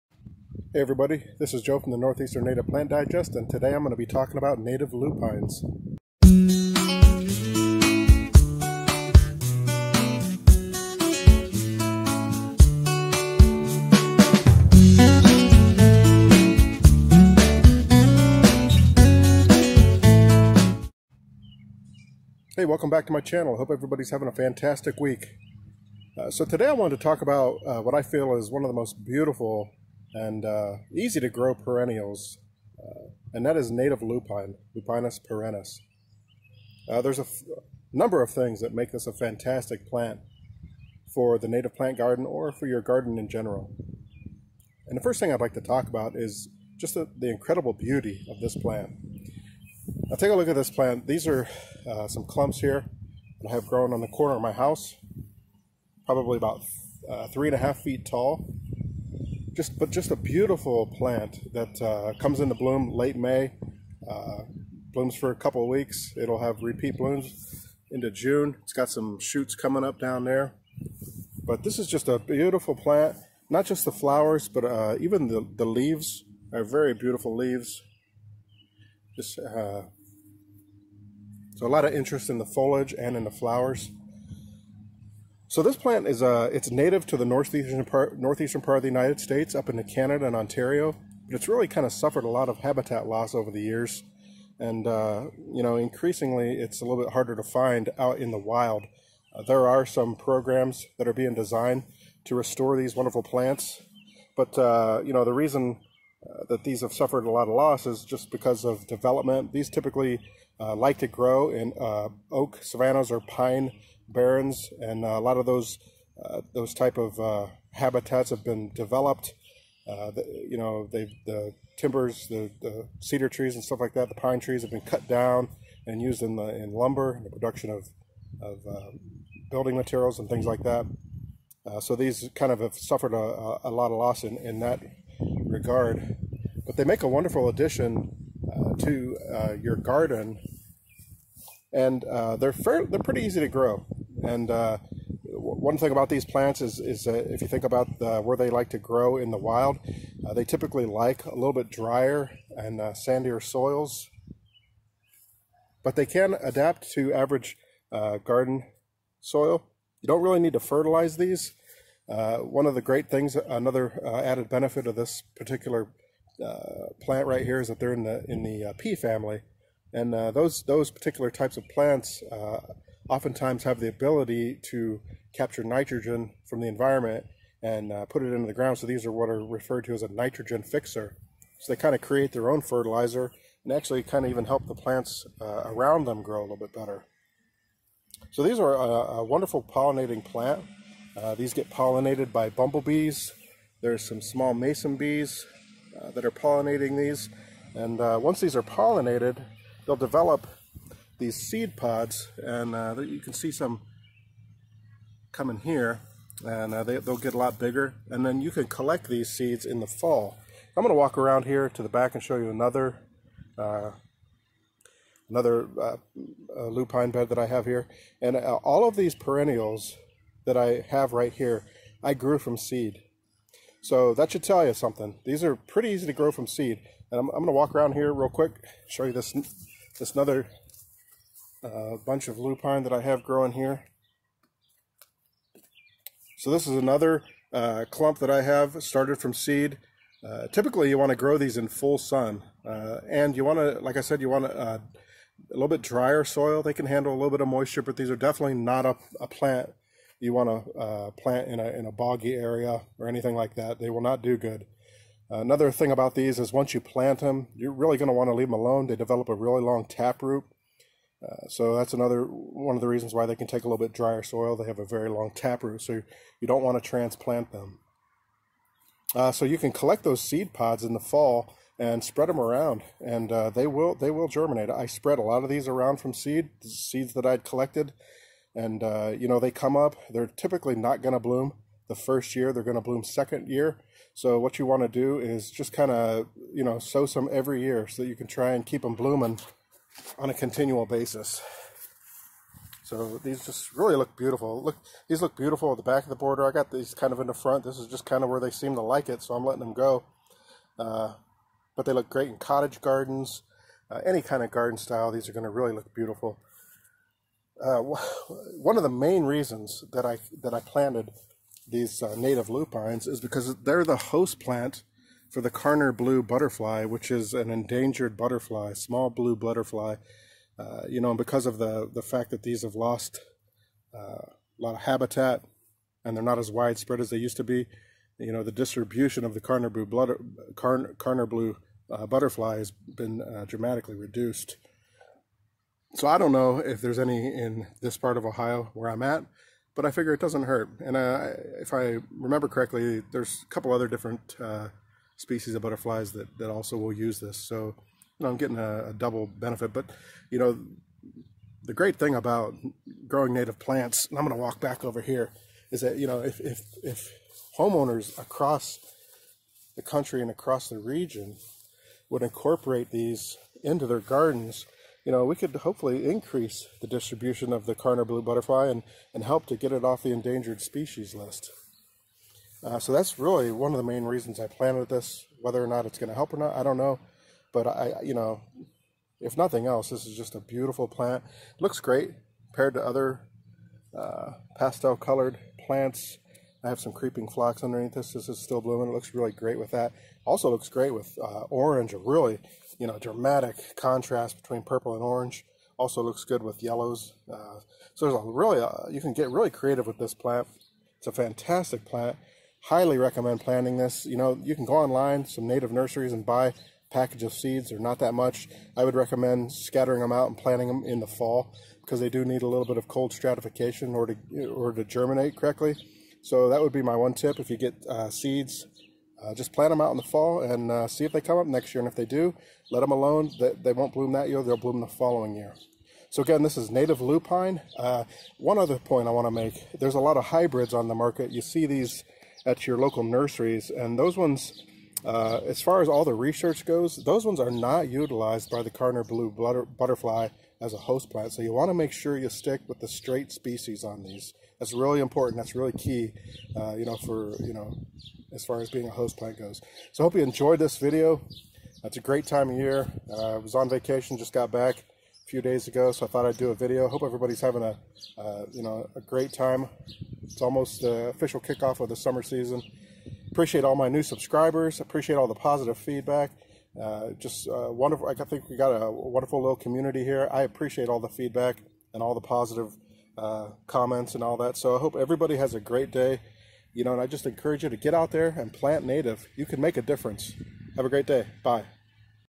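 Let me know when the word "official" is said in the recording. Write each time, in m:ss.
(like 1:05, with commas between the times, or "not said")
7:41.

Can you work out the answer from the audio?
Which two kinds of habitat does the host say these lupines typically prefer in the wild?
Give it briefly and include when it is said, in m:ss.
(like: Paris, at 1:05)
Oak savannas or pine barrens, at 1:52.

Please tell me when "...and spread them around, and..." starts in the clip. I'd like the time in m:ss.
4:31.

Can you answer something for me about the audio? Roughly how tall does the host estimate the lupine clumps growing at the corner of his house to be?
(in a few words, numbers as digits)
3.5 feet.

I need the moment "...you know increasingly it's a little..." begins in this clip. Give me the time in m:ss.
1:35.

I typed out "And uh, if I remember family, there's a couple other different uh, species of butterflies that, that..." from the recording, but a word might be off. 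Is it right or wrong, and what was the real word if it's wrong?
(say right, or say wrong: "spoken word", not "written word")
wrong: "correctly", not "family".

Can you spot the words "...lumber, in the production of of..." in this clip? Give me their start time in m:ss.
2:06.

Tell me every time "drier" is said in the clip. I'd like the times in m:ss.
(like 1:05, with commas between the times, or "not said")
2:31, 4:05, 4:23.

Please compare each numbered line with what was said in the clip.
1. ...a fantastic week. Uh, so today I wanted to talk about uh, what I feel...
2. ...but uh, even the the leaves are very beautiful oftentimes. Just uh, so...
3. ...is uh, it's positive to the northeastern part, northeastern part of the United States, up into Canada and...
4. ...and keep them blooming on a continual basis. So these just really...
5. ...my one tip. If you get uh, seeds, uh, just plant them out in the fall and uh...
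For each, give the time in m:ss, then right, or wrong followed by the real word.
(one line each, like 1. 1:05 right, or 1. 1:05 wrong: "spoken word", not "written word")
1. 0:24 right
2. 1:14 wrong: "leaves", not "oftentimes"
3. 1:26 wrong: "native", not "positive"
4. 4:48 right
5. 6:56 right.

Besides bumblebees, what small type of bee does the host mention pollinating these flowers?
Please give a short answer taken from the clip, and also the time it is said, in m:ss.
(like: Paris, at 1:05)
Mason bees, at 3:14.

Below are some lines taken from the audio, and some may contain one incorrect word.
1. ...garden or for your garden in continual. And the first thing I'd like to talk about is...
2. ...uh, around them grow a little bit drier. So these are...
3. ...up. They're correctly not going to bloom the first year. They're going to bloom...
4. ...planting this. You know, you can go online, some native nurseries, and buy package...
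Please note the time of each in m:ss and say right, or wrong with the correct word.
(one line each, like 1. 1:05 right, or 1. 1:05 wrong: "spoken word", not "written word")
1. 0:41 wrong: "general", not "continual"
2. 3:05 wrong: "better", not "drier"
3. 4:39 wrong: "typically", not "correctly"
4. 6:43 right.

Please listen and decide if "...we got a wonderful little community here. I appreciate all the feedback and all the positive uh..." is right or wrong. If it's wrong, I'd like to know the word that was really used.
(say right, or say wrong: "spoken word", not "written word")
right.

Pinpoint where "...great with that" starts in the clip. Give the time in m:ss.
6:29.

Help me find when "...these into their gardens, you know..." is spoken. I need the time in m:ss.
6:02.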